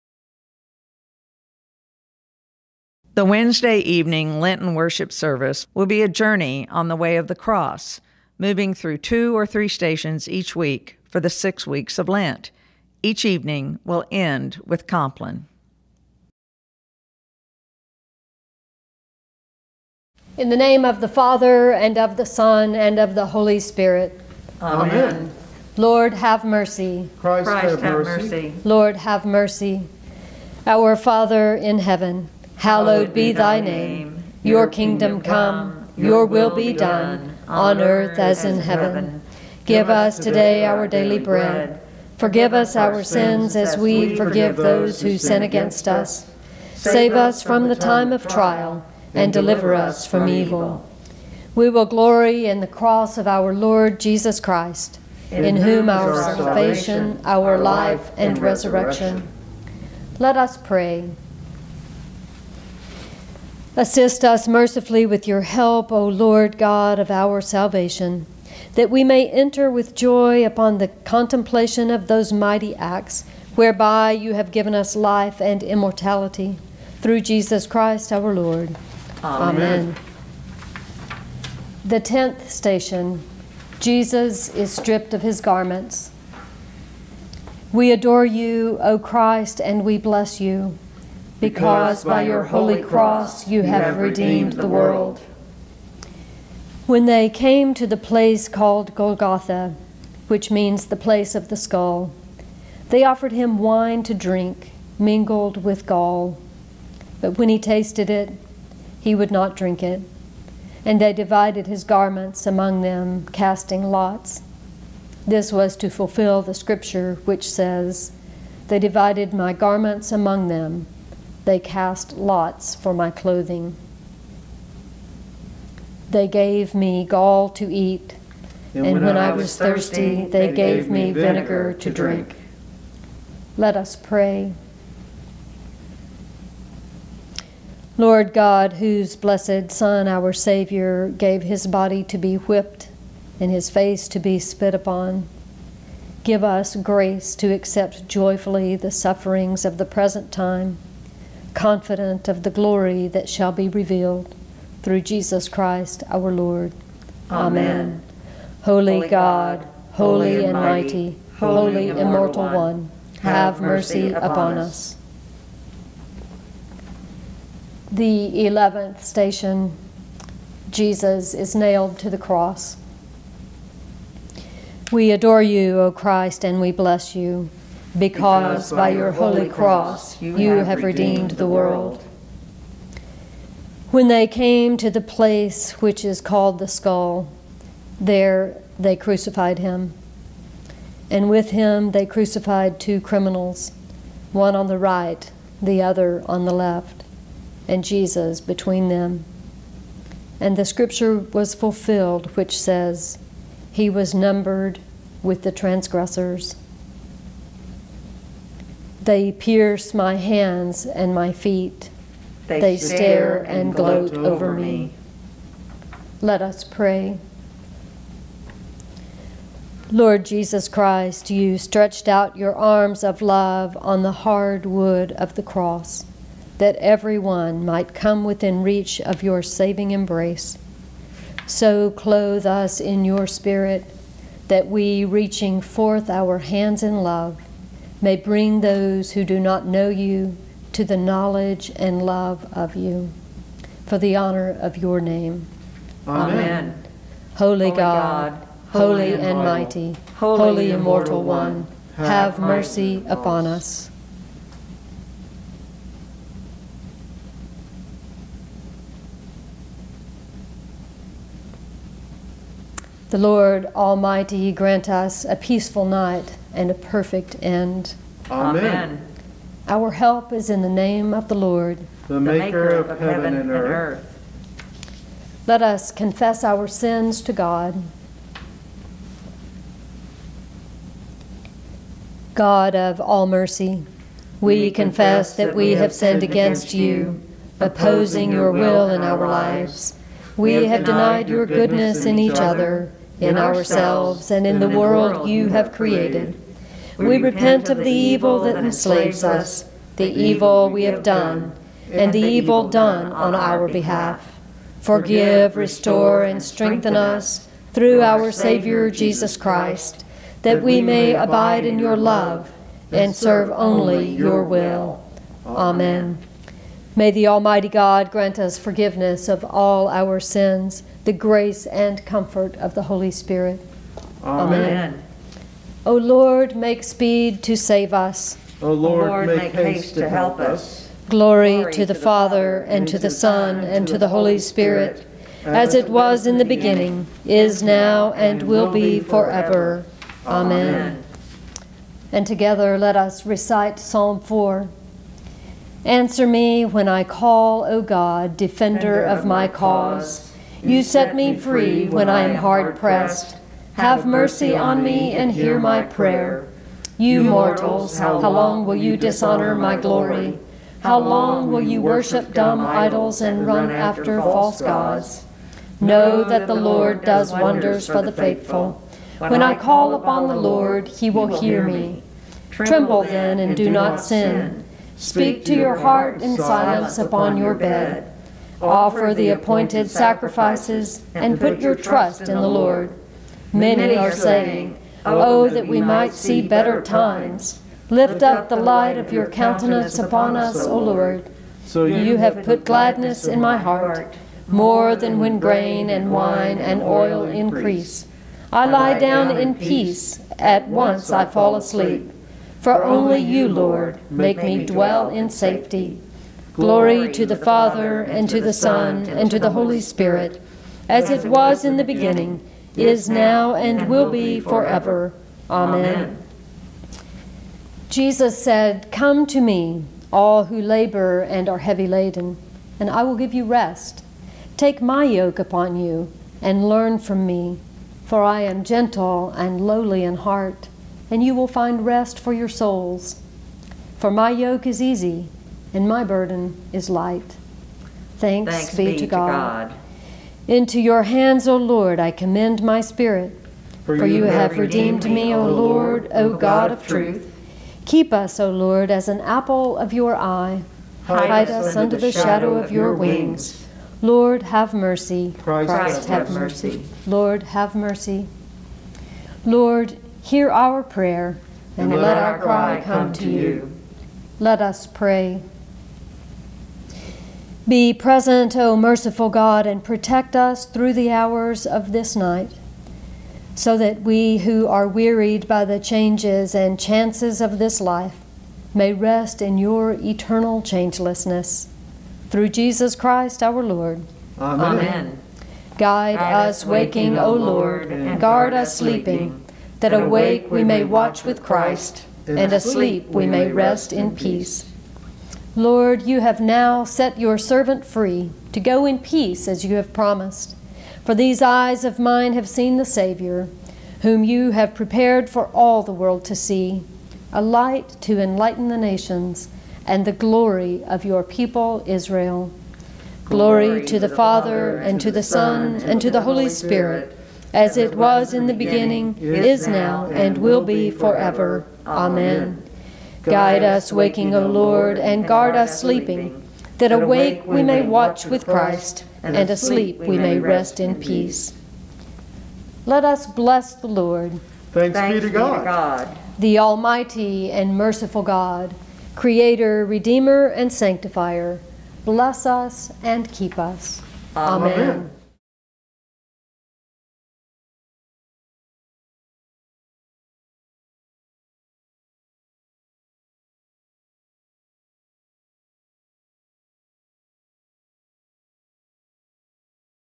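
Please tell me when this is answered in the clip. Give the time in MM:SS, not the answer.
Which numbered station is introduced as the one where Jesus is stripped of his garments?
01:21.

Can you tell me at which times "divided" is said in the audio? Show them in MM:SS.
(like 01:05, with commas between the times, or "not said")
01:51, 01:58.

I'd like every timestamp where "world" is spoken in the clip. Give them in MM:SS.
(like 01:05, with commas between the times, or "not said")
01:34, 03:01, 04:54, 08:25.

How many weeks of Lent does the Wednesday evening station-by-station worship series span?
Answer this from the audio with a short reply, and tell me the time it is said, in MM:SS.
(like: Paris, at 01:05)
6, at 00:11.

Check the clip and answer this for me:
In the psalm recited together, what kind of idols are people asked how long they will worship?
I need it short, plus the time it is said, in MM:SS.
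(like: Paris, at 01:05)
Dumb idols, at 06:02.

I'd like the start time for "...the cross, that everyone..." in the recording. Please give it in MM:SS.
03:45.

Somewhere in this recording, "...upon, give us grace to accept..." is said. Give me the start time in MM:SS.
02:24.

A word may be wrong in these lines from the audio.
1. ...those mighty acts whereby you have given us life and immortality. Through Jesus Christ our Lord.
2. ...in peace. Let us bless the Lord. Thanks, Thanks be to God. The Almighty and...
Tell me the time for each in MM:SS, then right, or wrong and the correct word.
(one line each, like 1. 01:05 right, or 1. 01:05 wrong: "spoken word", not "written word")
1. 01:12 right
2. 08:50 right.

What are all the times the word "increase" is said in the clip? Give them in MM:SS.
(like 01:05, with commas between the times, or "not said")
06:37.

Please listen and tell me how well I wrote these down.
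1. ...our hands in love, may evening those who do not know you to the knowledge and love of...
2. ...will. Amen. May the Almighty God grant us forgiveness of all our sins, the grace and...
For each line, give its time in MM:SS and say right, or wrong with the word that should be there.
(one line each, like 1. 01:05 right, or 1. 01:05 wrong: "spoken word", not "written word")
1. 03:56 wrong: "bring", not "evening"
2. 05:14 right.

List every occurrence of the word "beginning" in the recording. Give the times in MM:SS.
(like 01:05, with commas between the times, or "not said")
05:36, 06:51, 08:38.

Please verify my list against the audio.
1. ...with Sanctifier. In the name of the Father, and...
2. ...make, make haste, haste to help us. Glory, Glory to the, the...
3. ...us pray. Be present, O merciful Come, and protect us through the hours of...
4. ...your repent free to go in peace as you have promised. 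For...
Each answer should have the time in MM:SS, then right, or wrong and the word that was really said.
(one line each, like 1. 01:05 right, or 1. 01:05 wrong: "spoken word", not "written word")
1. 00:14 wrong: "Compline", not "Sanctifier"
2. 05:29 right
3. 07:44 wrong: "God", not "Come"
4. 08:17 wrong: "servant", not "repent".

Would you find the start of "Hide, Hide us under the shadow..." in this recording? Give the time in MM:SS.
07:31.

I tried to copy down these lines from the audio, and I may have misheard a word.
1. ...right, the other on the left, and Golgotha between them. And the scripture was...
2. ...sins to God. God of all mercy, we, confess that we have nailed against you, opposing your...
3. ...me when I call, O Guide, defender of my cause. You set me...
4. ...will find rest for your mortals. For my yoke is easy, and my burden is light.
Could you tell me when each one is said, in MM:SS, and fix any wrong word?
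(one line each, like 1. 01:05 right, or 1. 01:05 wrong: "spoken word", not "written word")
1. 03:14 wrong: "Jesus", not "Golgotha"
2. 04:36 wrong: "sinned", not "nailed"
3. 05:46 wrong: "God", not "Guide"
4. 07:11 wrong: "souls", not "mortals".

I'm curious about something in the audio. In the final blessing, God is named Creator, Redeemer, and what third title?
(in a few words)
Sanctifier.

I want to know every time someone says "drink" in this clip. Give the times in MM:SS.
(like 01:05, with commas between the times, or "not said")
01:44, 01:49, 02:11.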